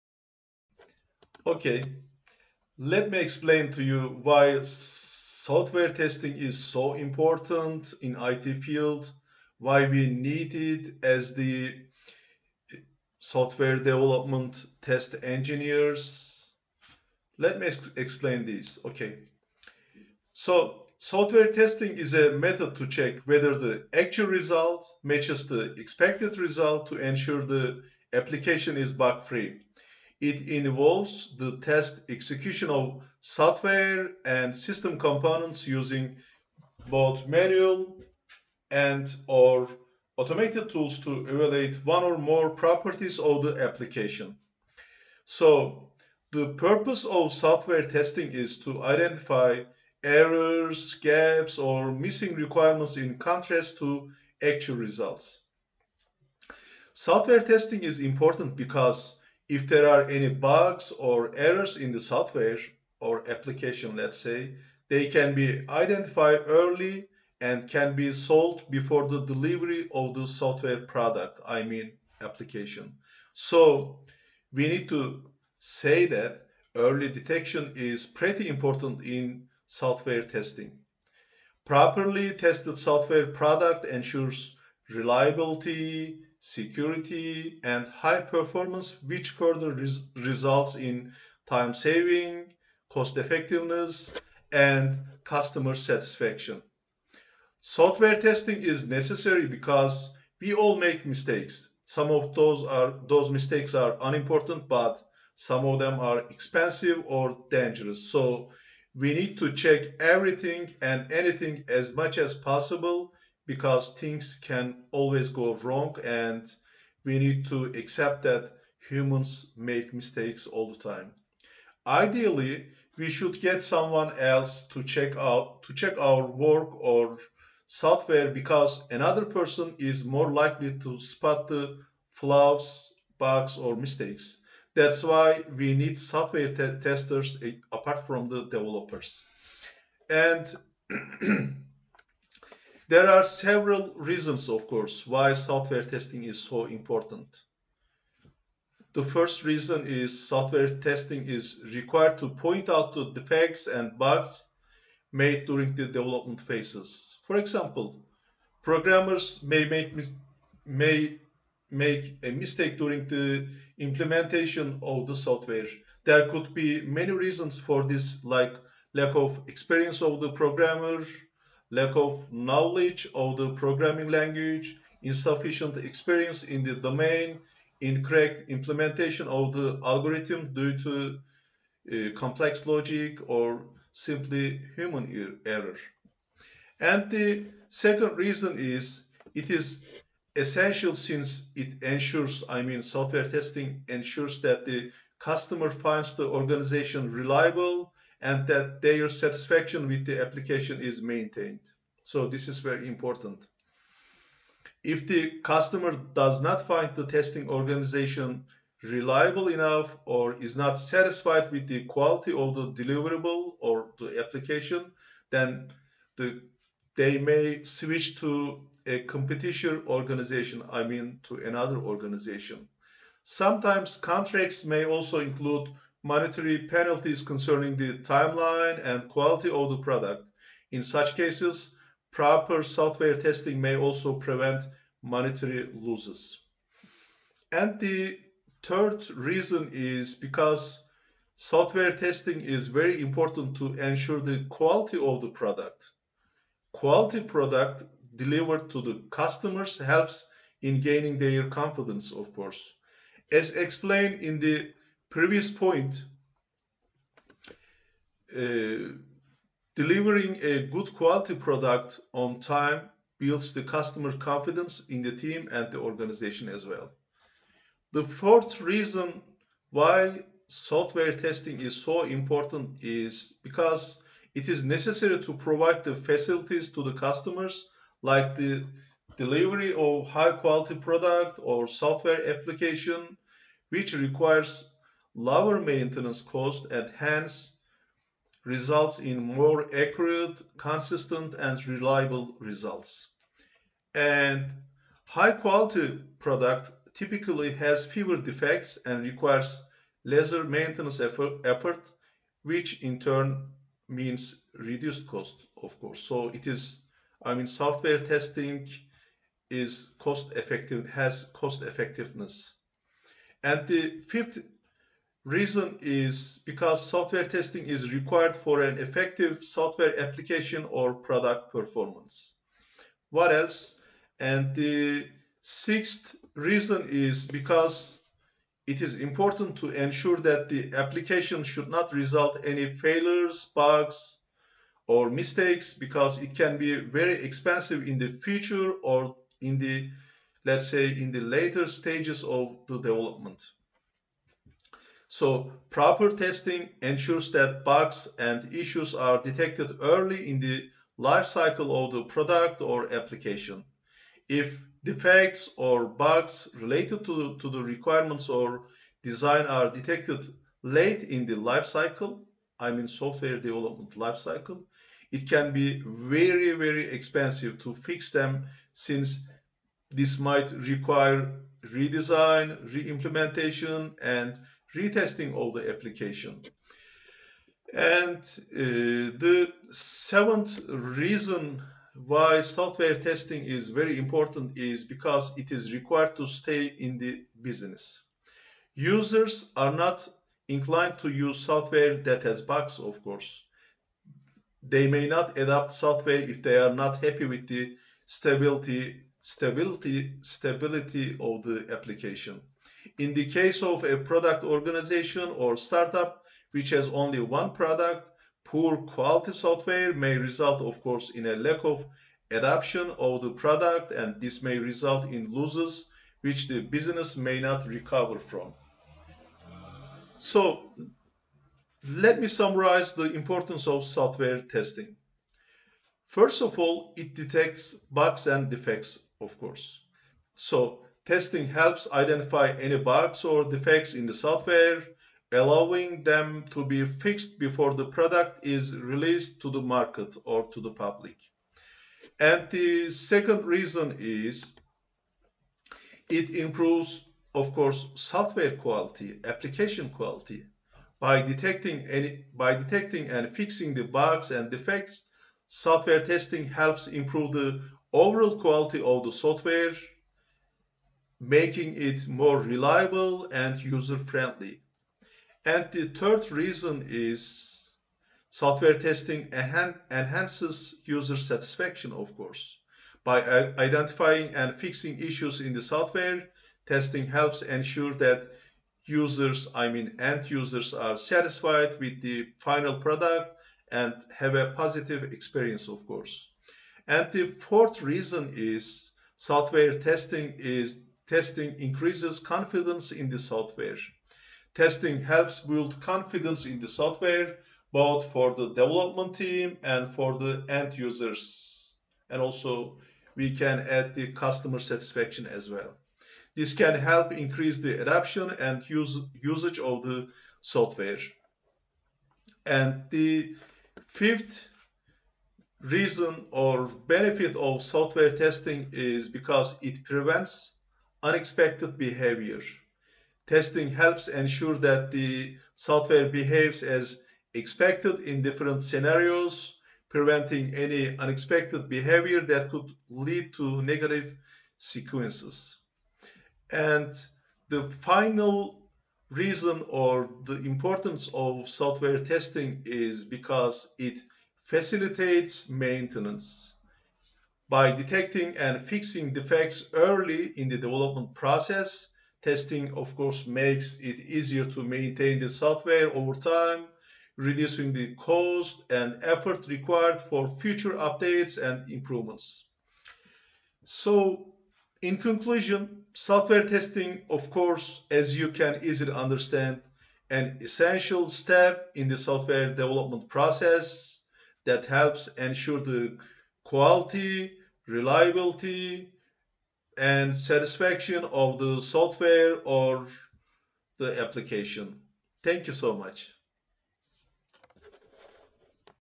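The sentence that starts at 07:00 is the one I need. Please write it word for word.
So, let me summarize the importance of software testing.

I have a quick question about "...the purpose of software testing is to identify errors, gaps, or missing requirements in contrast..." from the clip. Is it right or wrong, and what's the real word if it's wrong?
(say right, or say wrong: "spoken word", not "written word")
right.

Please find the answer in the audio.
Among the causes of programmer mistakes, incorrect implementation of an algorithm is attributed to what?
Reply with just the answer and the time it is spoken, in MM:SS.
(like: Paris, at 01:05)
complex logic, at 03:02.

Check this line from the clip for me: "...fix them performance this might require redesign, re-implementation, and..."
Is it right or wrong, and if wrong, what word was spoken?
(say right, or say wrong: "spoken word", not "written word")
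wrong: "since", not "performance".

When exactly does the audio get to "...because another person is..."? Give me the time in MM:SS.
02:08.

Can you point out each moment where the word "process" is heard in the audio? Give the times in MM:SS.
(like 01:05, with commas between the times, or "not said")
09:11, 09:33.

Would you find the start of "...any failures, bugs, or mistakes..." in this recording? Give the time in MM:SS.
05:32.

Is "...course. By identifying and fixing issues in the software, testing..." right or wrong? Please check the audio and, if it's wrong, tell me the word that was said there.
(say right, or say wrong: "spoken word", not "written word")
right.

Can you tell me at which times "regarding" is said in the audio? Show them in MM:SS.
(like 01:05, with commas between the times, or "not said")
not said.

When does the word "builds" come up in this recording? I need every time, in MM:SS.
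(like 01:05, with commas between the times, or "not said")
04:23, 08:15.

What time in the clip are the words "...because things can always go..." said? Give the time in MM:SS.
01:53.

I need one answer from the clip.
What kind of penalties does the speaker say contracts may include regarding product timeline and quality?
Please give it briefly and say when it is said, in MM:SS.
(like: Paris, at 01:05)
monetary penalties, at 03:46.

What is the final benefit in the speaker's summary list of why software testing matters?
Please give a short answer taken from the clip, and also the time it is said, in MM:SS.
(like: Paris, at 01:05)
facilitates maintenance, at 09:04.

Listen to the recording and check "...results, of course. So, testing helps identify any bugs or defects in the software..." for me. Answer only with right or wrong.
wrong.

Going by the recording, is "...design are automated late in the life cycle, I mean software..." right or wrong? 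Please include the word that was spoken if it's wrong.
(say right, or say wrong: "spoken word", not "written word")
wrong: "detected", not "automated".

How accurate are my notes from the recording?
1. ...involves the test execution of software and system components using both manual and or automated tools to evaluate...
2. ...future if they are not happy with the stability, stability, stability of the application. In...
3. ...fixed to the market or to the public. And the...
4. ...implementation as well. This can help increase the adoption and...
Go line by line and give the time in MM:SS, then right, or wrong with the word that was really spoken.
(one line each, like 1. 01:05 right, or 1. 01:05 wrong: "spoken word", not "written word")
1. 00:30 right
2. 06:35 wrong: "software", not "future"
3. 07:18 wrong: "released", not "fixed"
4. 08:24 wrong: "satisfaction", not "implementation".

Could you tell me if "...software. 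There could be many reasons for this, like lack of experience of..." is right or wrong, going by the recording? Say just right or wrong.
right.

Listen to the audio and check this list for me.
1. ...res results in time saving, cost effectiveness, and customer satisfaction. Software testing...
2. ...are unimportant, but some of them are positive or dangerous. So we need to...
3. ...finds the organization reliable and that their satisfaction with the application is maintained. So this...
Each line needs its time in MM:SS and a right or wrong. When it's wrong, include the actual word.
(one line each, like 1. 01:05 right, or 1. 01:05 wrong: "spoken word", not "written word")
1. 01:29 right
2. 01:43 wrong: "expensive", not "positive"
3. 03:15 right.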